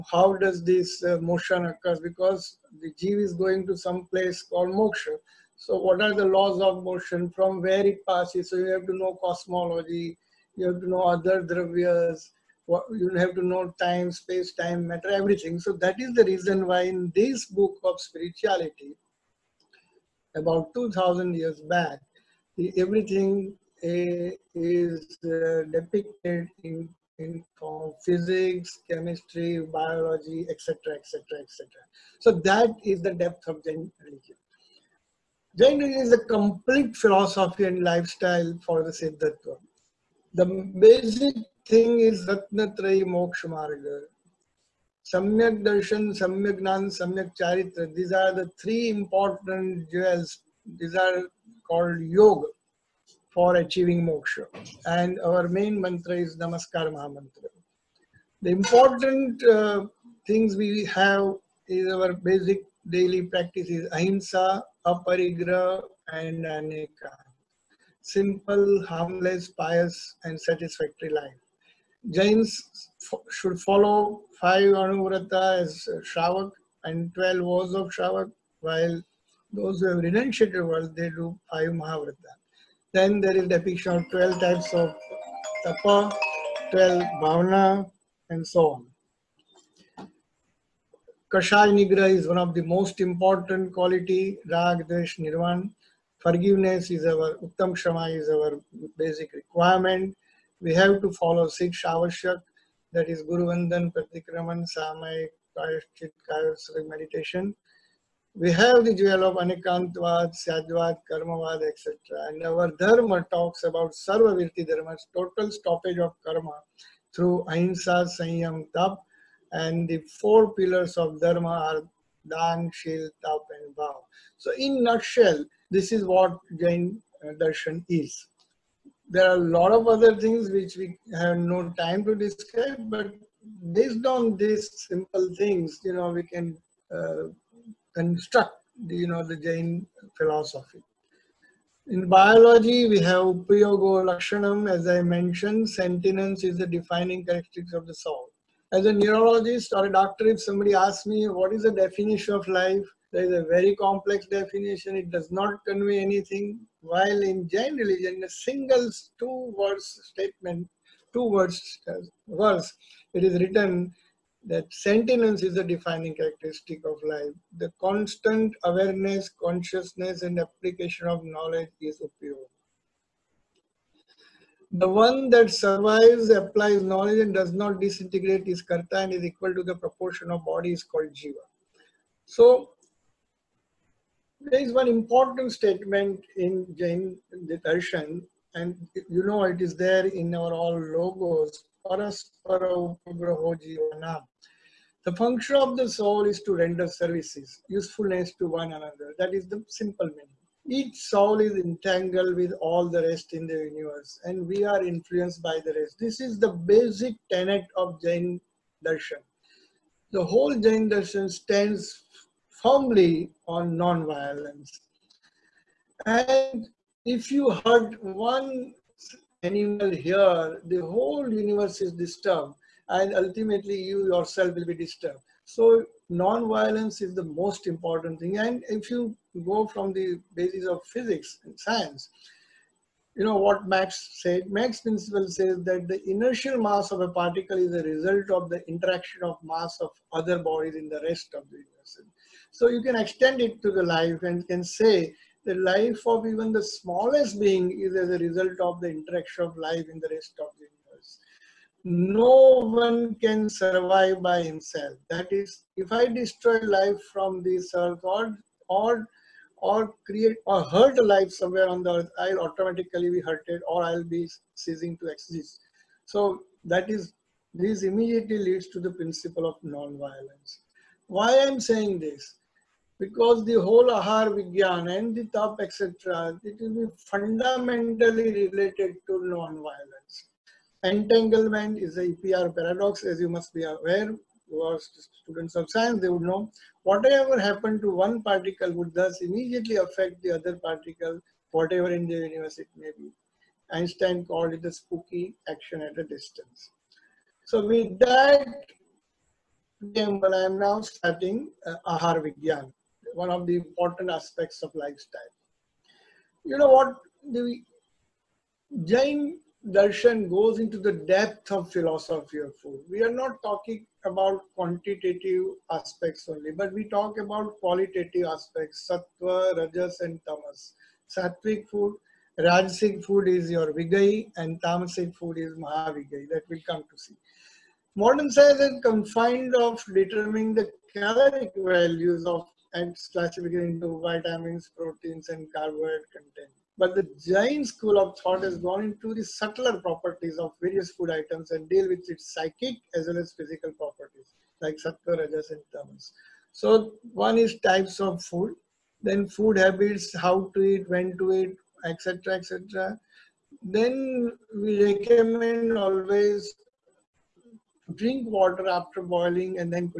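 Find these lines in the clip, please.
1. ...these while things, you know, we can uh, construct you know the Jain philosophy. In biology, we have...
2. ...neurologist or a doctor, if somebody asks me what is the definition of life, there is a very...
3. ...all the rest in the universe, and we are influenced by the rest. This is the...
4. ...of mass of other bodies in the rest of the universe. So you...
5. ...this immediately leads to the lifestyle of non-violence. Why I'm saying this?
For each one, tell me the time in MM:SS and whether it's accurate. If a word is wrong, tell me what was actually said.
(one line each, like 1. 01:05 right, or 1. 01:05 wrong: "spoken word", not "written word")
1. 02:14 wrong: "simple", not "while"
2. 02:28 right
3. 03:22 right
4. 03:59 right
5. 04:27 wrong: "principle", not "lifestyle".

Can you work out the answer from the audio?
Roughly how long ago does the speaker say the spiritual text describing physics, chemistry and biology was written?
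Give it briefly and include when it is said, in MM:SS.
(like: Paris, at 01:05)
2000 years, at 00:20.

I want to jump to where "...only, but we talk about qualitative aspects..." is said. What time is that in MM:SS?
05:16.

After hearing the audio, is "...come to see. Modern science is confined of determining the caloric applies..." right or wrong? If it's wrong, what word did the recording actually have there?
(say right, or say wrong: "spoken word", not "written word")
wrong: "values", not "applies".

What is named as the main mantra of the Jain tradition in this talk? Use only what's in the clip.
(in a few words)
Namaskar Mahamantra.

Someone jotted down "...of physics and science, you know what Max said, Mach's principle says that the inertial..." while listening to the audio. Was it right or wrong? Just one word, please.
right.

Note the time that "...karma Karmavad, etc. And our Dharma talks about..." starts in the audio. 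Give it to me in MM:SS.
01:50.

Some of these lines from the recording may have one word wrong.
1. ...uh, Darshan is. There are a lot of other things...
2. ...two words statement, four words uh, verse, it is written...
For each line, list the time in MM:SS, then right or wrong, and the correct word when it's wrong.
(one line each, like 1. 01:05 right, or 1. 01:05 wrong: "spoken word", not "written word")
1. 02:07 right
2. 02:39 wrong: "two", not "four".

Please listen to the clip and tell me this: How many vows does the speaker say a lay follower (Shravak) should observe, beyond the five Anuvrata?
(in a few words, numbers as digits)
12.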